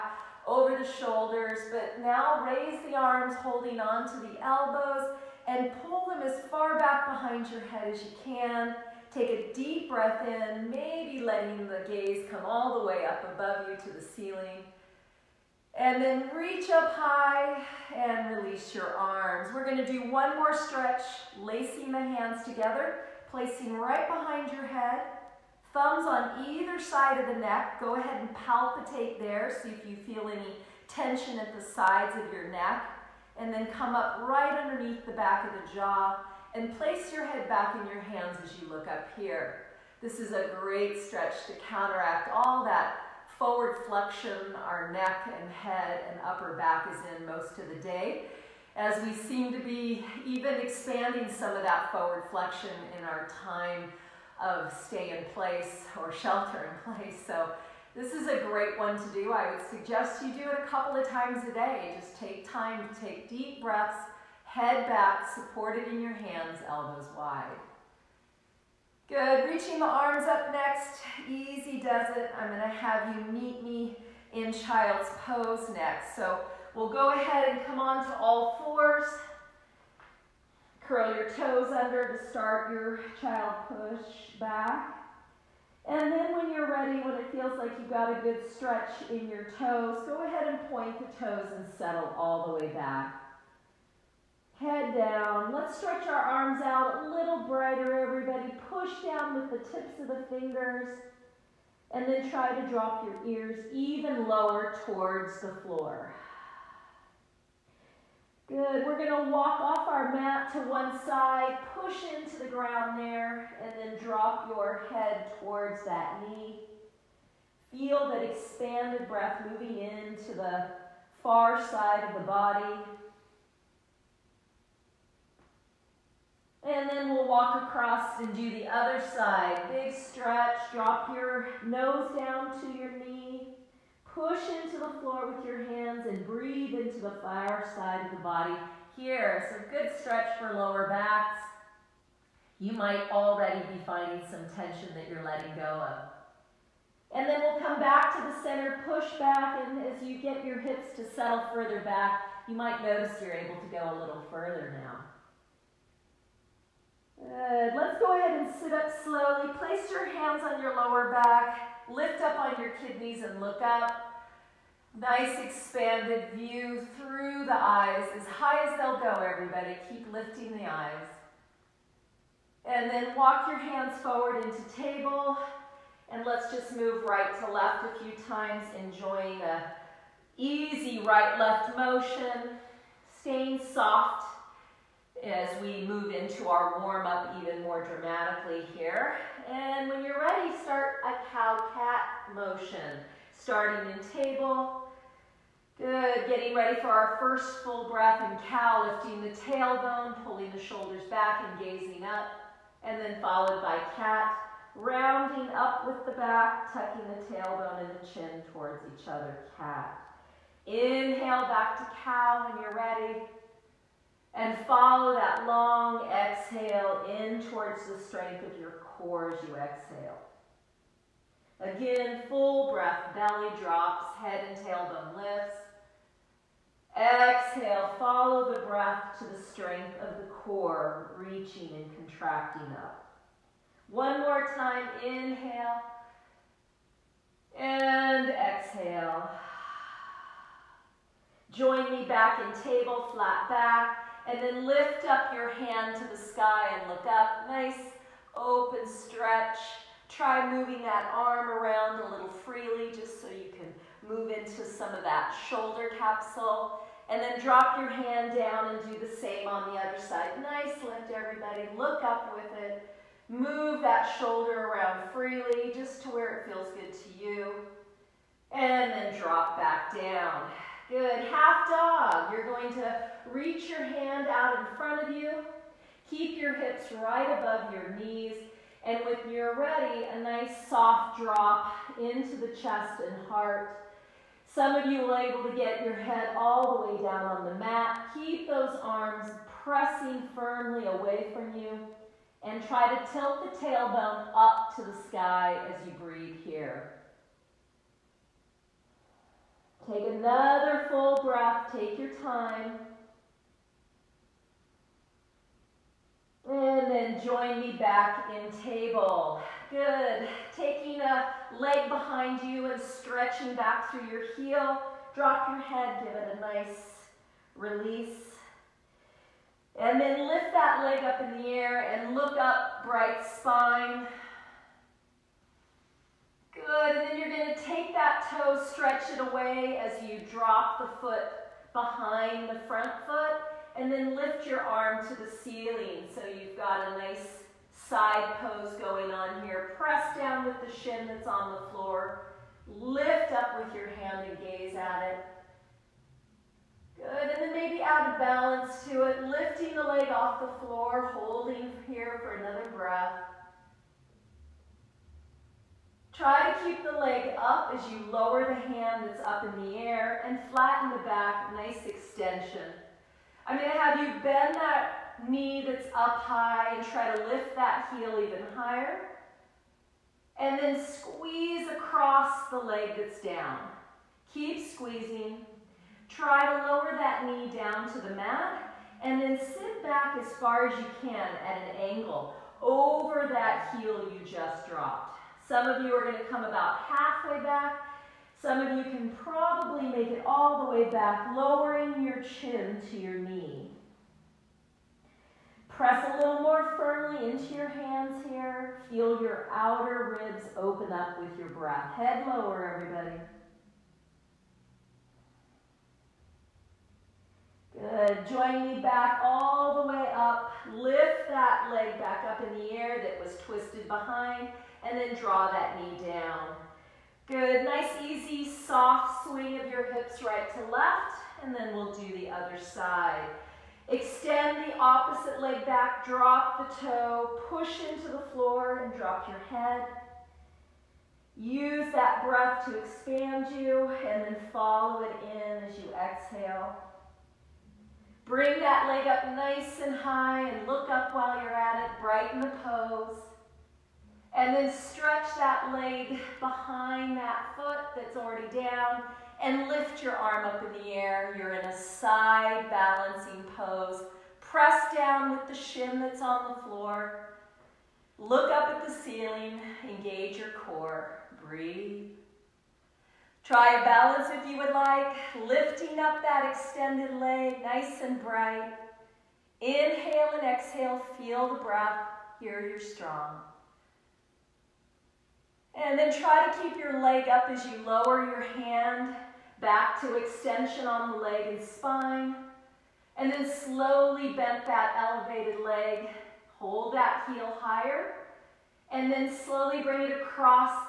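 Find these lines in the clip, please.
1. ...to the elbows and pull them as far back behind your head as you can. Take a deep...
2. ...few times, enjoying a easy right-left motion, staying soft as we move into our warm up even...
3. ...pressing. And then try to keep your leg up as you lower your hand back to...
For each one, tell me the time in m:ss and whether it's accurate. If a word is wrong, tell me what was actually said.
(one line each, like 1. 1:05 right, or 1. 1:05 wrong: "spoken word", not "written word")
1. 0:04 right
2. 2:58 right
3. 7:52 wrong: "strong", not "pressing".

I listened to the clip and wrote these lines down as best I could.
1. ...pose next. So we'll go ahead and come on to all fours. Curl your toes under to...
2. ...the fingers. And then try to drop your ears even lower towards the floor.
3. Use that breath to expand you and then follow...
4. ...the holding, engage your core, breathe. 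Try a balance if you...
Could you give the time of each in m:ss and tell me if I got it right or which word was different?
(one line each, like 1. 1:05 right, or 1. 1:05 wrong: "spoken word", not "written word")
1. 1:15 right
2. 1:40 right
3. 7:11 right
4. 7:38 wrong: "ceiling", not "holding".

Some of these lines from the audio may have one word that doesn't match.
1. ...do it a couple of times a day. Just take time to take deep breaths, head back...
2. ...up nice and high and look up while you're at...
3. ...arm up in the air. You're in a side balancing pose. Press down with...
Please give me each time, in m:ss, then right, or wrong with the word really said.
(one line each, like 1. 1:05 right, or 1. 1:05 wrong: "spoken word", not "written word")
1. 1:00 right
2. 7:19 right
3. 7:30 right.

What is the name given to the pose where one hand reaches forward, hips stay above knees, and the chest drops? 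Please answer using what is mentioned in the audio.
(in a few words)
Half dog.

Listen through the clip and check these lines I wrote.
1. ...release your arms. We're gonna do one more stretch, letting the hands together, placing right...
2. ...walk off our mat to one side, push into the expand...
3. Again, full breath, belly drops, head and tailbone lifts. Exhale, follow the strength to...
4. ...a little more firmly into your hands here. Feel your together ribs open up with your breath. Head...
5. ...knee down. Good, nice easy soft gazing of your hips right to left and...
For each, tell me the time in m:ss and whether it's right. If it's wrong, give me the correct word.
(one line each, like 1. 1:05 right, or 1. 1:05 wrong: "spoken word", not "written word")
1. 0:18 wrong: "lacing", not "letting"
2. 1:49 wrong: "ground", not "expand"
3. 3:41 wrong: "breath", not "strength"
4. 6:36 wrong: "outer", not "together"
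5. 6:55 wrong: "swing", not "gazing".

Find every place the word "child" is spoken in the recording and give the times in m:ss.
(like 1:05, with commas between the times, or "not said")
1:14, 1:23.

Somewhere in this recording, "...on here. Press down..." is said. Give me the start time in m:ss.
5:39.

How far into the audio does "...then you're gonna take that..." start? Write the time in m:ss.
5:27.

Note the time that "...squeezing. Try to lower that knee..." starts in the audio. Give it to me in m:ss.
6:14.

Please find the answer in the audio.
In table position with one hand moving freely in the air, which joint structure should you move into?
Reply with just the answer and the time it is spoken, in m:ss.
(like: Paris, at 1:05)
Shoulder capsule, at 4:15.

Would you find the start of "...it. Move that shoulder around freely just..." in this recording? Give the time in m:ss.
4:22.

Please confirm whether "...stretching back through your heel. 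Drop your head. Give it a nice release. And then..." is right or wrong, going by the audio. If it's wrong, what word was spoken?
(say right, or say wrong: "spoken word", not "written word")
right.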